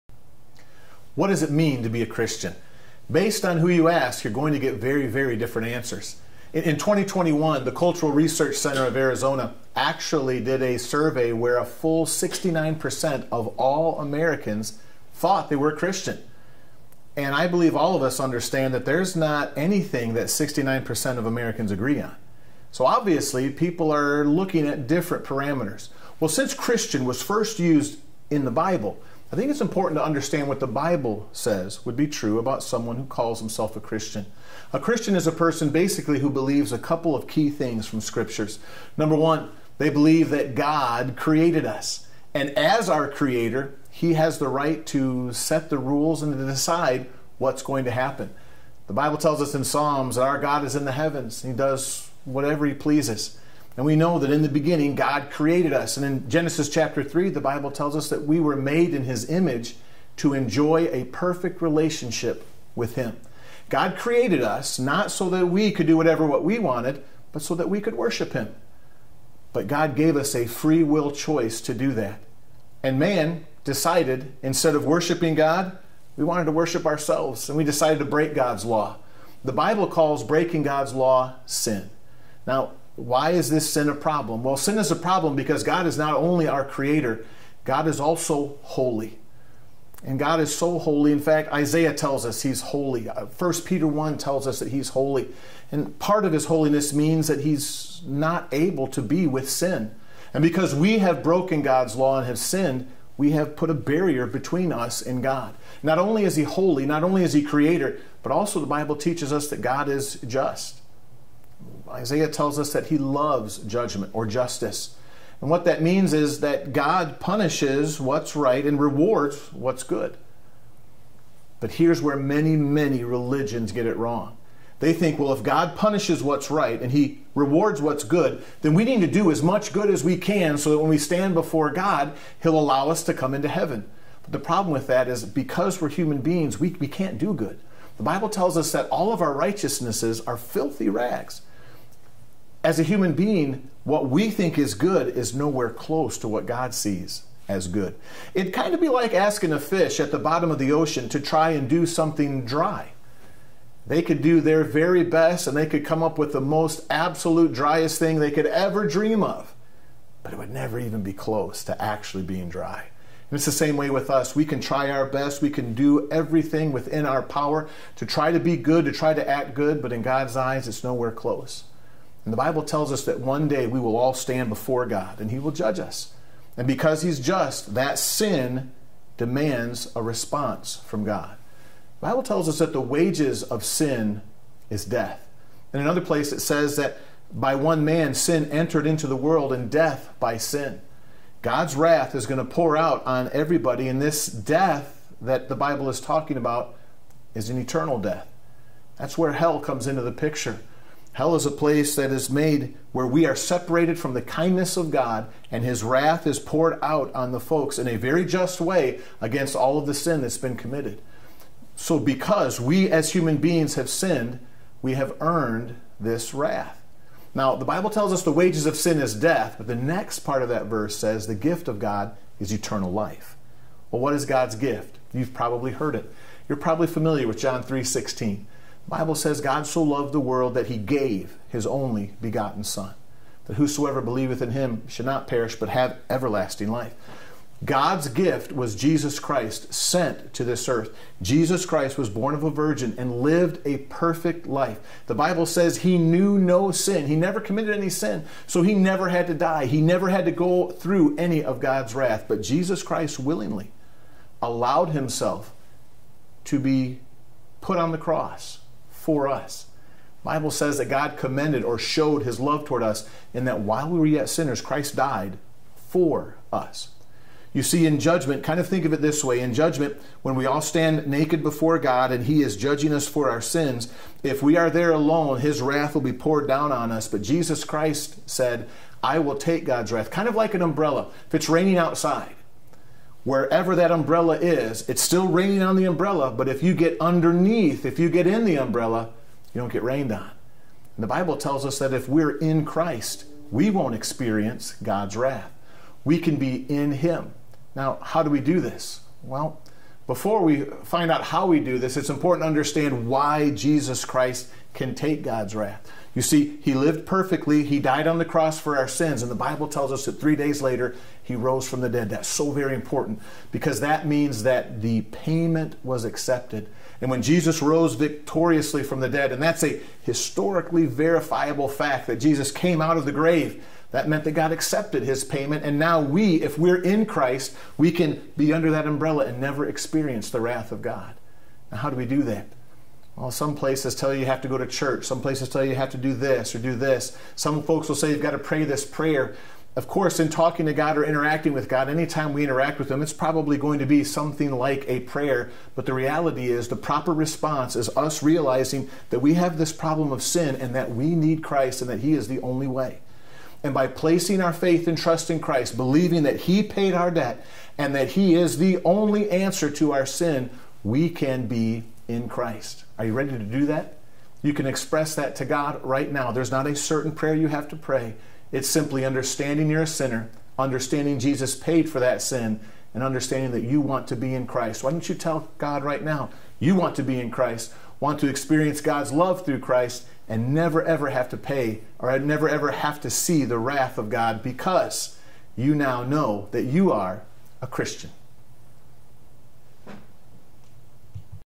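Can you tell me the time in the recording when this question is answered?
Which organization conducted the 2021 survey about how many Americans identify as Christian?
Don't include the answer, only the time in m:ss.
0:07.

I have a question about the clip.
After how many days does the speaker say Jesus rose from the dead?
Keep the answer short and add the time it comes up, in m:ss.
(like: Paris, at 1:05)
3, at 5:10.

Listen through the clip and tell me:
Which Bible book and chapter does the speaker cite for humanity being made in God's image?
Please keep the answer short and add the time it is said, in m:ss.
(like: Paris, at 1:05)
Genesis chapter 3, at 0:56.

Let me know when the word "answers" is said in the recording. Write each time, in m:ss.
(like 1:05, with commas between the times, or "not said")
0:05, 5:59.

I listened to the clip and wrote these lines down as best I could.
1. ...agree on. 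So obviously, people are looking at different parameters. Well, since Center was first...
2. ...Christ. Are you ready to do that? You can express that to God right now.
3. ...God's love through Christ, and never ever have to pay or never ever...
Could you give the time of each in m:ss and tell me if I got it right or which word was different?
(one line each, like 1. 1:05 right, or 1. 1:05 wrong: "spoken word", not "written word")
1. 0:21 wrong: "Christian", not "Center"
2. 6:02 right
3. 6:18 right.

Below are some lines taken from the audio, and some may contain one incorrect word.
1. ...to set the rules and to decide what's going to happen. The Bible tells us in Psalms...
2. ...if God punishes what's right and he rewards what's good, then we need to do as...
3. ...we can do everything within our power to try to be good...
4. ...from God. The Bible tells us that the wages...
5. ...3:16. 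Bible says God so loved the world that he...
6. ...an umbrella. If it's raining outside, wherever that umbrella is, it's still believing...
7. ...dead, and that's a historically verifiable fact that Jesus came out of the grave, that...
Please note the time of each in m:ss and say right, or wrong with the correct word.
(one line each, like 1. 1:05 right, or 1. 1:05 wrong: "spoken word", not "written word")
1. 0:44 right
2. 2:05 right
3. 2:45 right
4. 3:00 right
5. 3:47 right
6. 4:40 wrong: "raining", not "believing"
7. 5:19 right.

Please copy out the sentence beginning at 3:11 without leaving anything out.
God's wrath is going to pour out on everybody, and this death that the Bible is talking about is an eternal death.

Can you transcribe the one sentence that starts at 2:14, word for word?
But the problem with that is because we're human beings, we, we can't do good.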